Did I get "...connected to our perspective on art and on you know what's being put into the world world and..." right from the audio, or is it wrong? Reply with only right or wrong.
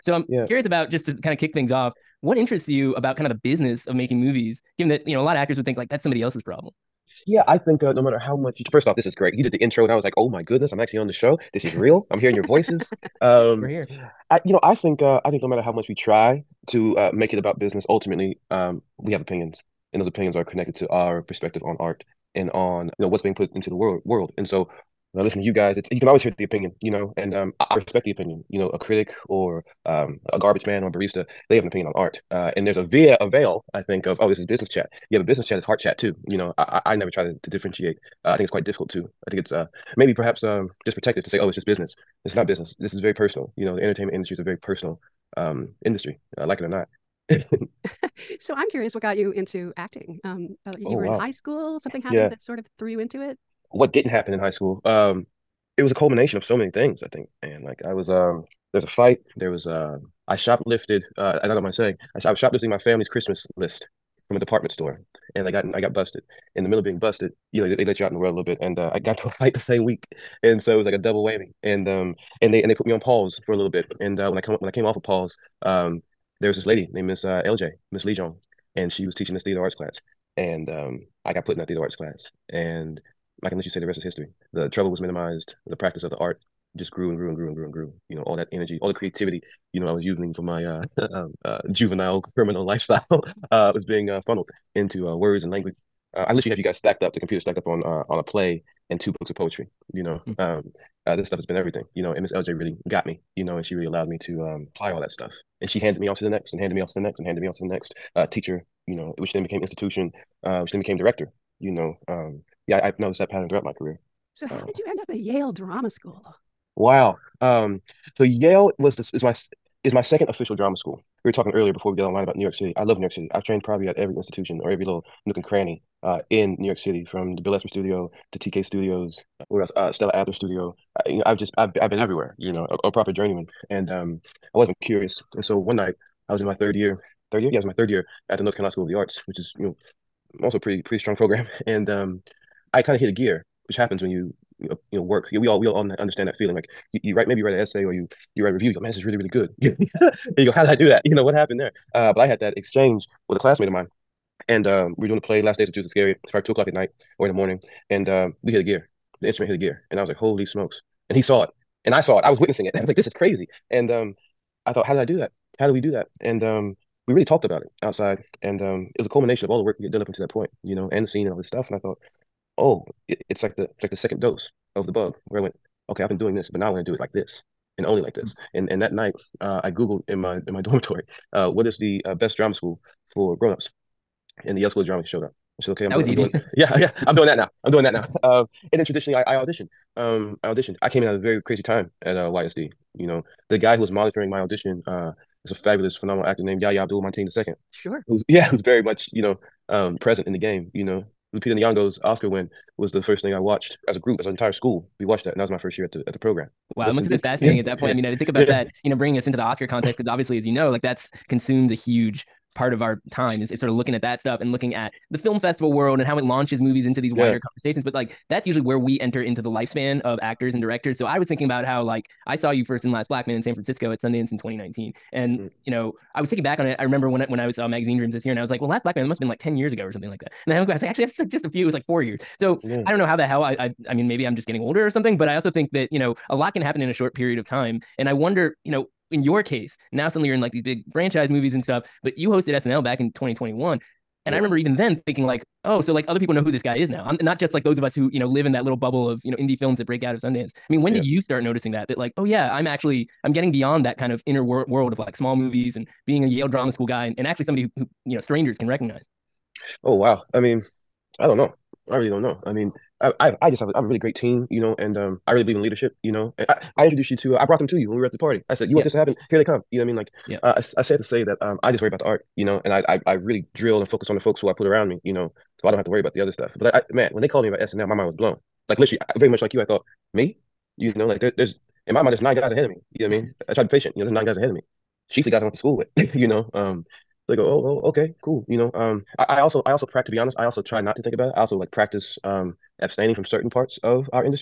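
right.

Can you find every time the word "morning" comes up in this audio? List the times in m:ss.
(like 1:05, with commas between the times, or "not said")
2:37.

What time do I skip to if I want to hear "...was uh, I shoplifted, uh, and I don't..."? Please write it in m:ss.
0:59.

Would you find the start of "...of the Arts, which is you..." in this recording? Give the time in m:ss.
2:18.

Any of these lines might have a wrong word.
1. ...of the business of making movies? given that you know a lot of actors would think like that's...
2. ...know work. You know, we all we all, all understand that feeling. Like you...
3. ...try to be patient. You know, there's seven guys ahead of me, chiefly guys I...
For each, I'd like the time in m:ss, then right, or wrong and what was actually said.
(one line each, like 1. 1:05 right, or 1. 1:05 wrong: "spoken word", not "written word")
1. 0:03 right
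2. 2:24 right
3. 4:43 wrong: "nine", not "seven".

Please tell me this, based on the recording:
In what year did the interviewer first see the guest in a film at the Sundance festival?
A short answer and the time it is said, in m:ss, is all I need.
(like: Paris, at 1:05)
2019, at 3:44.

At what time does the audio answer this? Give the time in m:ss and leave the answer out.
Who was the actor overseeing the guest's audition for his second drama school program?
3:16.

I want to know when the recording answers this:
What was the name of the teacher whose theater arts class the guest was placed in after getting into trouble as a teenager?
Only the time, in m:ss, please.
1:17.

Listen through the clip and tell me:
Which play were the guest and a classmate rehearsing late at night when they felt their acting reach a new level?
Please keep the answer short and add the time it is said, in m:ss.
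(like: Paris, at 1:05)
Last Days of Judas Iscariot, at 2:35.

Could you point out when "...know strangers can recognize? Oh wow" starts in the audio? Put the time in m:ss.
4:18.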